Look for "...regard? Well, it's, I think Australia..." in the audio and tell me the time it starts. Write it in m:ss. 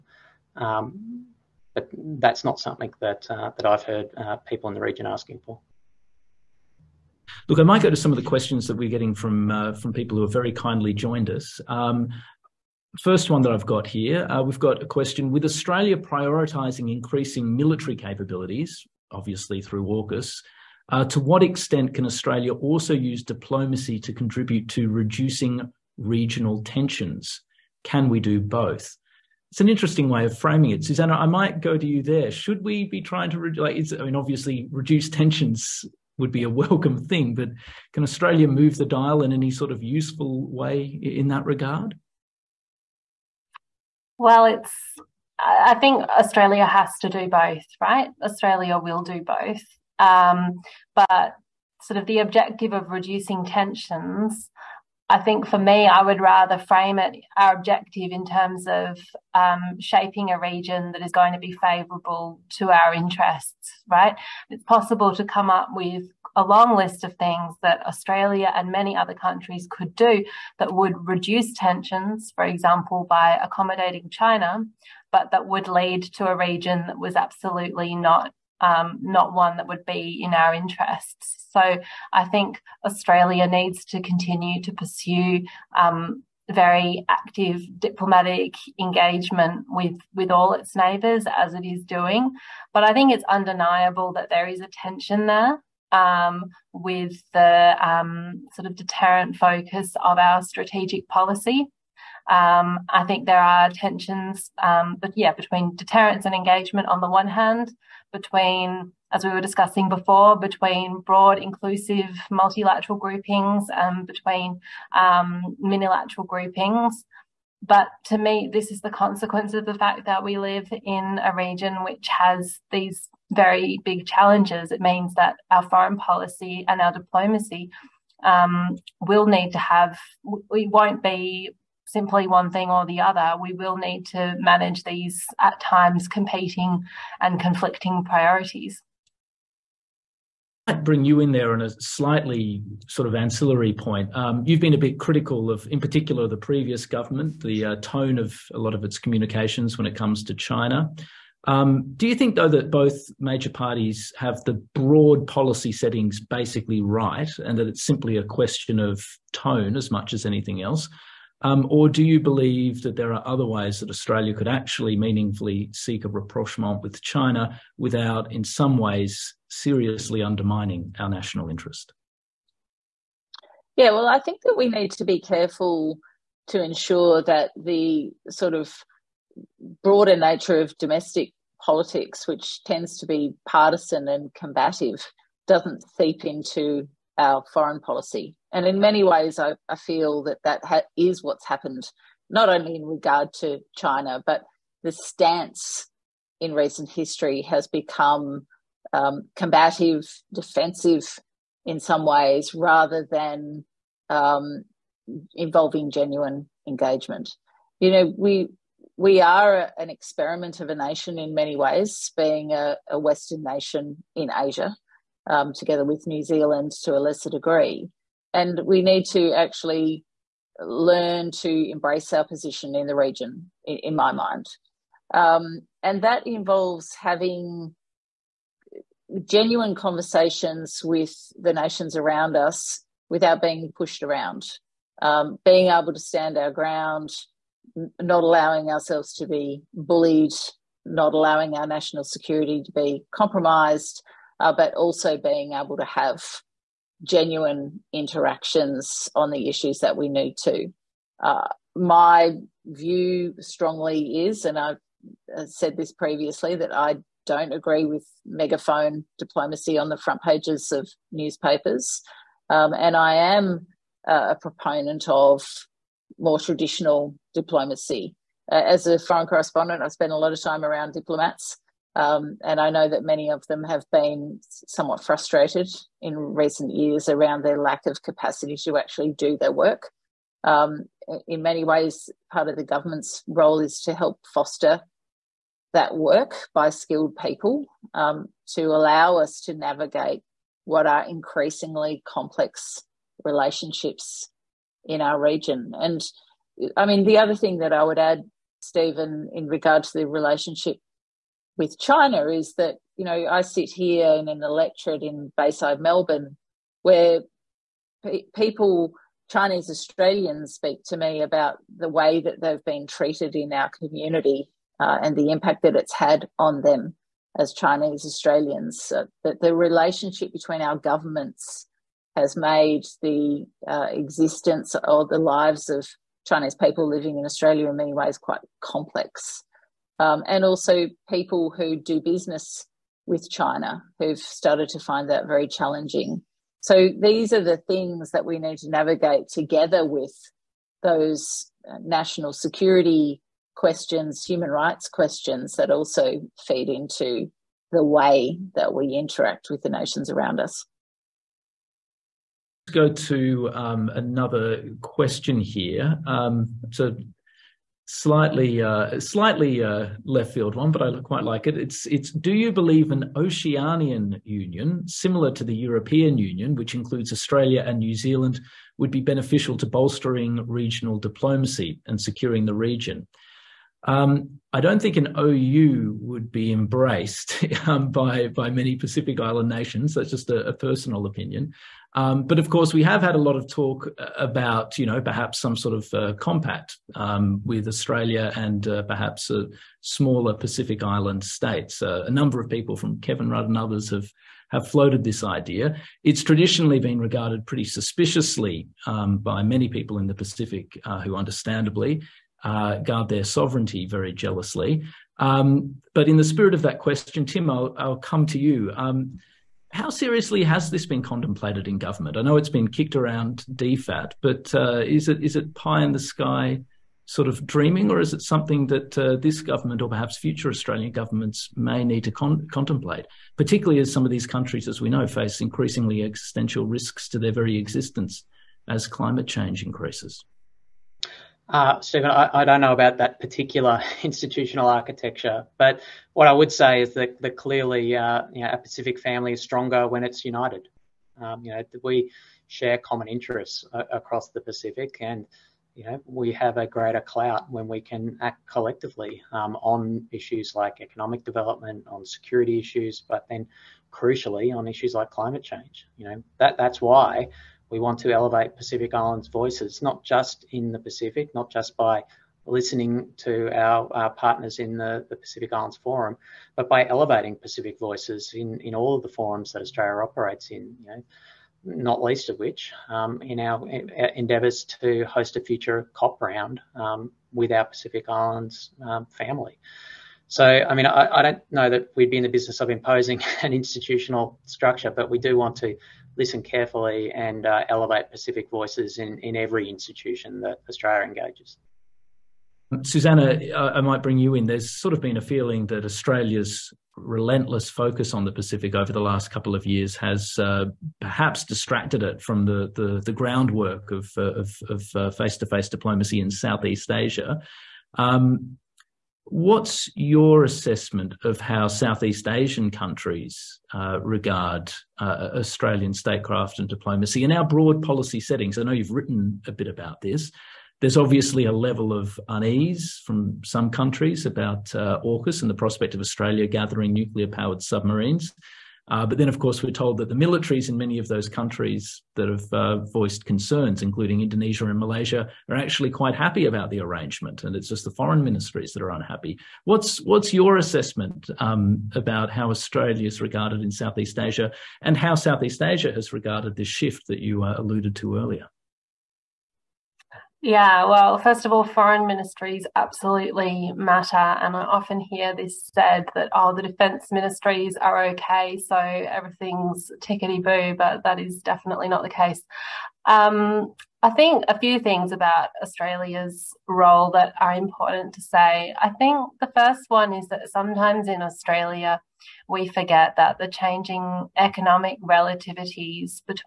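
0:41.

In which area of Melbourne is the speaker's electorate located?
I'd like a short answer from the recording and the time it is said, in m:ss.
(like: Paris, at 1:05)
Bayside, at 5:05.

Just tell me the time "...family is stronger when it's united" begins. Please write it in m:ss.
7:18.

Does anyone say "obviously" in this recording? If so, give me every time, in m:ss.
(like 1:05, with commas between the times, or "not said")
0:19, 0:34, 8:40.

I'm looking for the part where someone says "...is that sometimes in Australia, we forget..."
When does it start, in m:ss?
9:30.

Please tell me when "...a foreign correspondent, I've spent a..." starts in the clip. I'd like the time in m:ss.
4:28.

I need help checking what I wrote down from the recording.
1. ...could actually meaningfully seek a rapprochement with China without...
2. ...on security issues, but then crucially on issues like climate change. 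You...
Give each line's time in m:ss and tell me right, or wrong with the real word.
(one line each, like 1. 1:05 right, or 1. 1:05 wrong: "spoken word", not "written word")
1. 2:44 right
2. 7:31 right.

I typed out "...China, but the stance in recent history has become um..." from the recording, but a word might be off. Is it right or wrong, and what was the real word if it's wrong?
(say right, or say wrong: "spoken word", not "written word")
right.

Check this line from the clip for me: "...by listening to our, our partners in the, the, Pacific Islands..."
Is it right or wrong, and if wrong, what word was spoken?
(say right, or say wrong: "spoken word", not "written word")
right.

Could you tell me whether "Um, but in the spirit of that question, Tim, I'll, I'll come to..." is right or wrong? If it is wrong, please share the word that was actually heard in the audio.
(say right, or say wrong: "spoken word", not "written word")
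right.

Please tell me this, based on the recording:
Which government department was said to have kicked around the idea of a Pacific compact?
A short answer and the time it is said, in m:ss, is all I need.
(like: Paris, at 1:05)
DFAT, at 6:53.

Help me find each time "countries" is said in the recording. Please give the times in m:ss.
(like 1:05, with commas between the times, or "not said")
1:09, 7:04, 8:32, 8:43, 8:51.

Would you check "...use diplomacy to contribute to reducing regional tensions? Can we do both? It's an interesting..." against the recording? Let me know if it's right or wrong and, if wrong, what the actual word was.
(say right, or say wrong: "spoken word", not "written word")
right.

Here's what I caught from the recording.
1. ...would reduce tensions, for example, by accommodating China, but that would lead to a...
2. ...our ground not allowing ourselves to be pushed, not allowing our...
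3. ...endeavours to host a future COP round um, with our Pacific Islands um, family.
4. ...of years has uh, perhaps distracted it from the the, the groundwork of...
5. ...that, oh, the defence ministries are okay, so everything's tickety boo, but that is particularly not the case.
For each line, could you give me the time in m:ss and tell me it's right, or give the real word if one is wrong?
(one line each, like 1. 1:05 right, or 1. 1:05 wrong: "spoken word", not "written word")
1. 1:10 right
2. 3:56 wrong: "bullied", not "pushed"
3. 7:54 right
4. 8:19 right
5. 9:16 wrong: "definitely", not "particularly".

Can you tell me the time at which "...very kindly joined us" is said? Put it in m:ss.
0:10.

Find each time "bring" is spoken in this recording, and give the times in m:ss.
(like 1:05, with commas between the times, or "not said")
2:20, 8:14.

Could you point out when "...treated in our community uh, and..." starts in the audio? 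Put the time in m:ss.
5:12.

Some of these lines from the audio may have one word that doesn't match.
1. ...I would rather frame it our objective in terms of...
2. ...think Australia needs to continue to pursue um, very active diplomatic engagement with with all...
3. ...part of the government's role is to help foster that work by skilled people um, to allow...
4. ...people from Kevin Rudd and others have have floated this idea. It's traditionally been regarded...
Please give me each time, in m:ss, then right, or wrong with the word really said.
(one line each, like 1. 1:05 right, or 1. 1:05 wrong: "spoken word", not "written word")
1. 0:55 right
2. 1:22 right
3. 4:42 right
4. 6:32 right.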